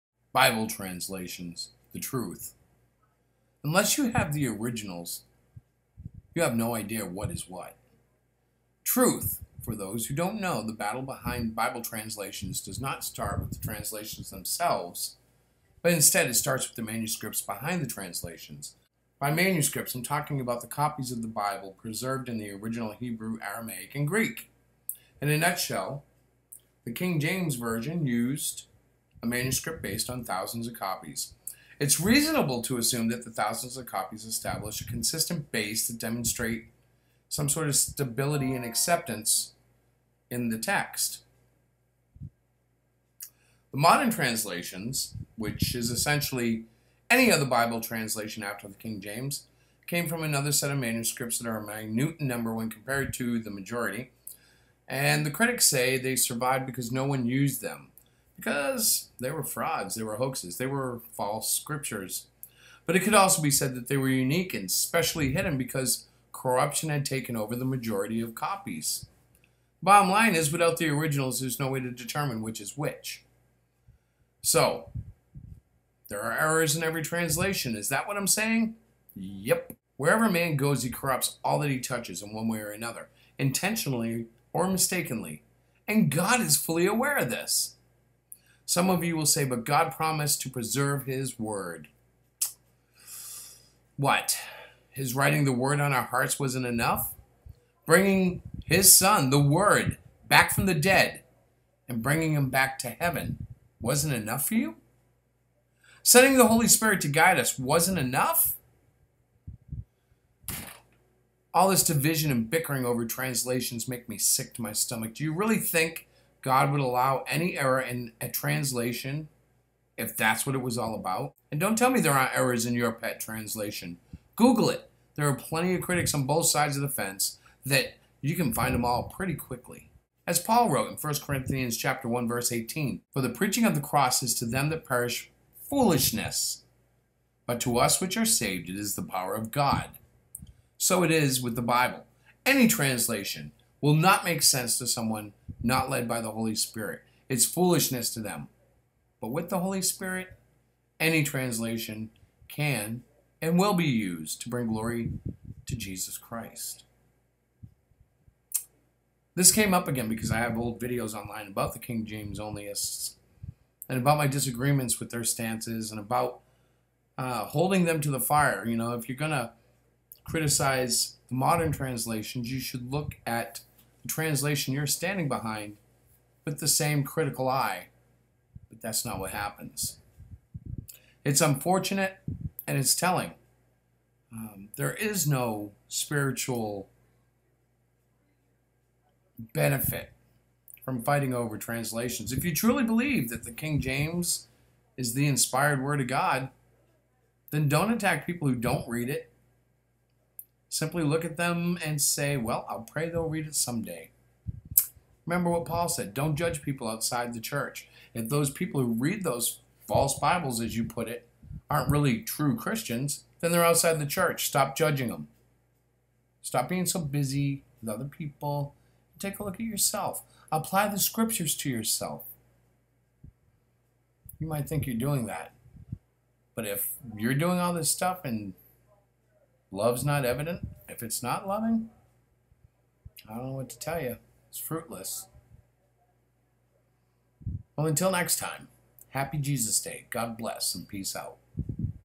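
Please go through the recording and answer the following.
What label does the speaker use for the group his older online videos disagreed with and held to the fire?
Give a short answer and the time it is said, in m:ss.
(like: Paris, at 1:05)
King James onlyists, at 2:41.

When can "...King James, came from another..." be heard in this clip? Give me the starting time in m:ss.
0:48.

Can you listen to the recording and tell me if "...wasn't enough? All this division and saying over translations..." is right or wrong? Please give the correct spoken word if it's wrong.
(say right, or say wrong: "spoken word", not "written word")
wrong: "bickering", not "saying".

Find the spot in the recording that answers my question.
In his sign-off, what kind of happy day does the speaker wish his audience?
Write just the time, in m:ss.
3:59.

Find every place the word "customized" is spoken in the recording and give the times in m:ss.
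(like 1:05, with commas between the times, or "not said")
not said.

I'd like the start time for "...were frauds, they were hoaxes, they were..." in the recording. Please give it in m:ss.
0:59.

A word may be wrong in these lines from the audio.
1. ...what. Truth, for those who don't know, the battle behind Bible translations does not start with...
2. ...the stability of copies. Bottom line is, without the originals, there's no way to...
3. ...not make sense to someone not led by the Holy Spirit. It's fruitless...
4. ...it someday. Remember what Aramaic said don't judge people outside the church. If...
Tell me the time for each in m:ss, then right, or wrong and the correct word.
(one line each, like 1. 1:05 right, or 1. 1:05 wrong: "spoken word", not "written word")
1. 0:07 right
2. 1:07 wrong: "majority", not "stability"
3. 2:23 wrong: "foolishness", not "fruitless"
4. 3:23 wrong: "Paul", not "Aramaic".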